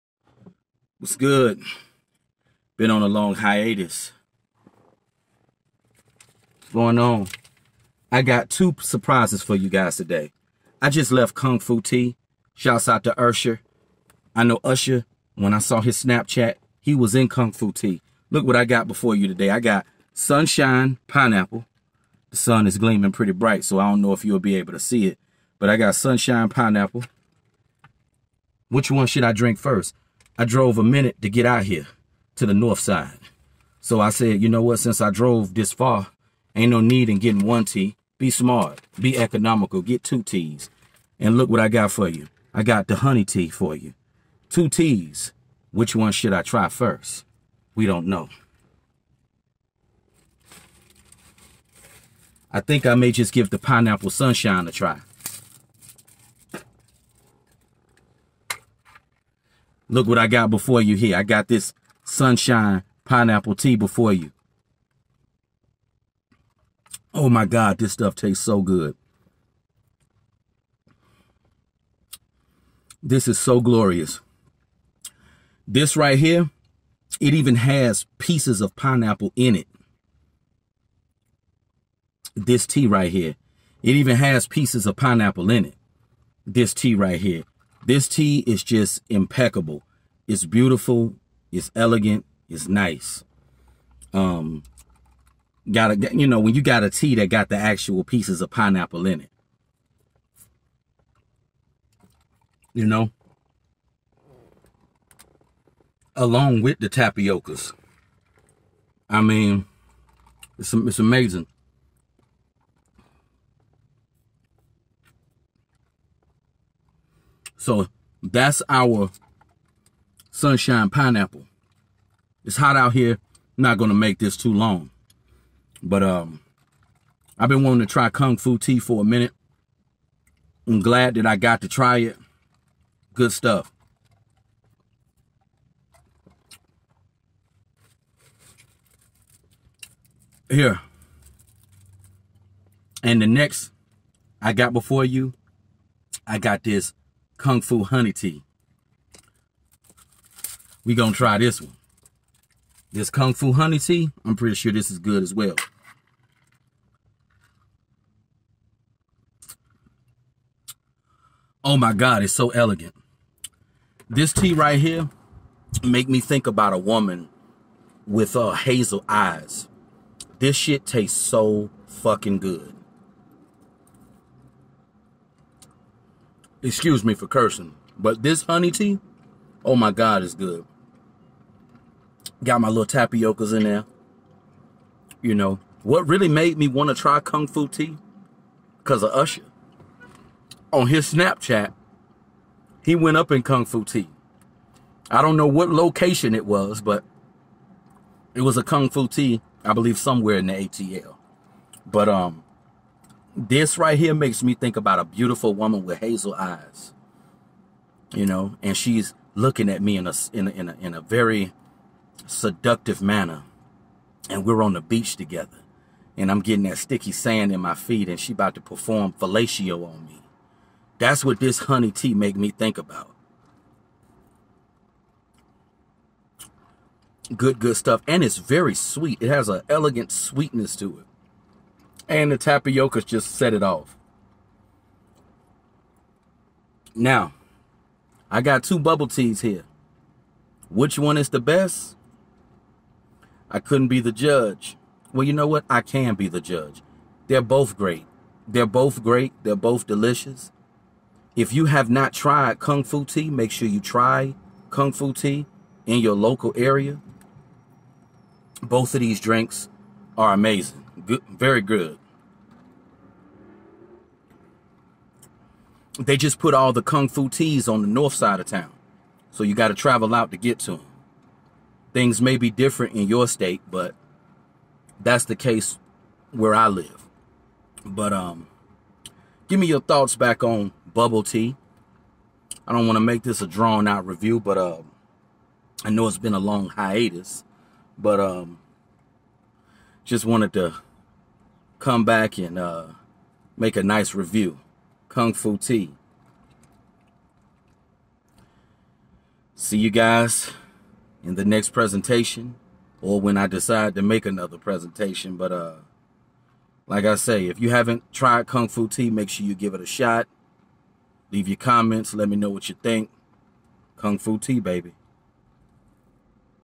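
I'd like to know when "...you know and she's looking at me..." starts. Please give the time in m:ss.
3:28.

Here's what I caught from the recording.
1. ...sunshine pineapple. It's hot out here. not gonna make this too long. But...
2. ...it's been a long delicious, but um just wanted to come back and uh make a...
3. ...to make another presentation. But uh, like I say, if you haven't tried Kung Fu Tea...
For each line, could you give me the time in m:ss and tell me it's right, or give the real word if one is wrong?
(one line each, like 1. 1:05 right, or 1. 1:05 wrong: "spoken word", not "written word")
1. 2:00 right
2. 4:46 wrong: "hiatus", not "delicious"
3. 5:03 right.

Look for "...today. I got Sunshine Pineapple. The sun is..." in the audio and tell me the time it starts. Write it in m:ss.
0:19.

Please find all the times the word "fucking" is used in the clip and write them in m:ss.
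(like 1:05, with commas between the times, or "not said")
2:51.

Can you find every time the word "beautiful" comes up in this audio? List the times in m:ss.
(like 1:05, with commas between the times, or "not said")
1:30, 3:25.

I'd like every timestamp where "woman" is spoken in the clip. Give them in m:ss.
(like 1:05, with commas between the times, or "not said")
2:46, 3:25.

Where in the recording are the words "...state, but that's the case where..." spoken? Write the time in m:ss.
4:33.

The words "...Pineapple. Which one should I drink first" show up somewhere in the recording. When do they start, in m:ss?
0:26.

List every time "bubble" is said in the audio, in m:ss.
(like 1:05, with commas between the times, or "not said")
3:58, 4:40.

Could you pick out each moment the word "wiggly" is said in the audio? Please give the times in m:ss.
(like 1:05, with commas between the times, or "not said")
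not said.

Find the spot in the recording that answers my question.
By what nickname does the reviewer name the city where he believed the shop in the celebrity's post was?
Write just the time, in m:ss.
3:20.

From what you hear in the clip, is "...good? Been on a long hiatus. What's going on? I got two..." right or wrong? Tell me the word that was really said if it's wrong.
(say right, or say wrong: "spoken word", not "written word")
right.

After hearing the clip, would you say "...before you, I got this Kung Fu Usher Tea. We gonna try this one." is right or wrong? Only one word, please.
wrong.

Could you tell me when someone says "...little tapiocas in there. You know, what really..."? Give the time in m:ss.
3:02.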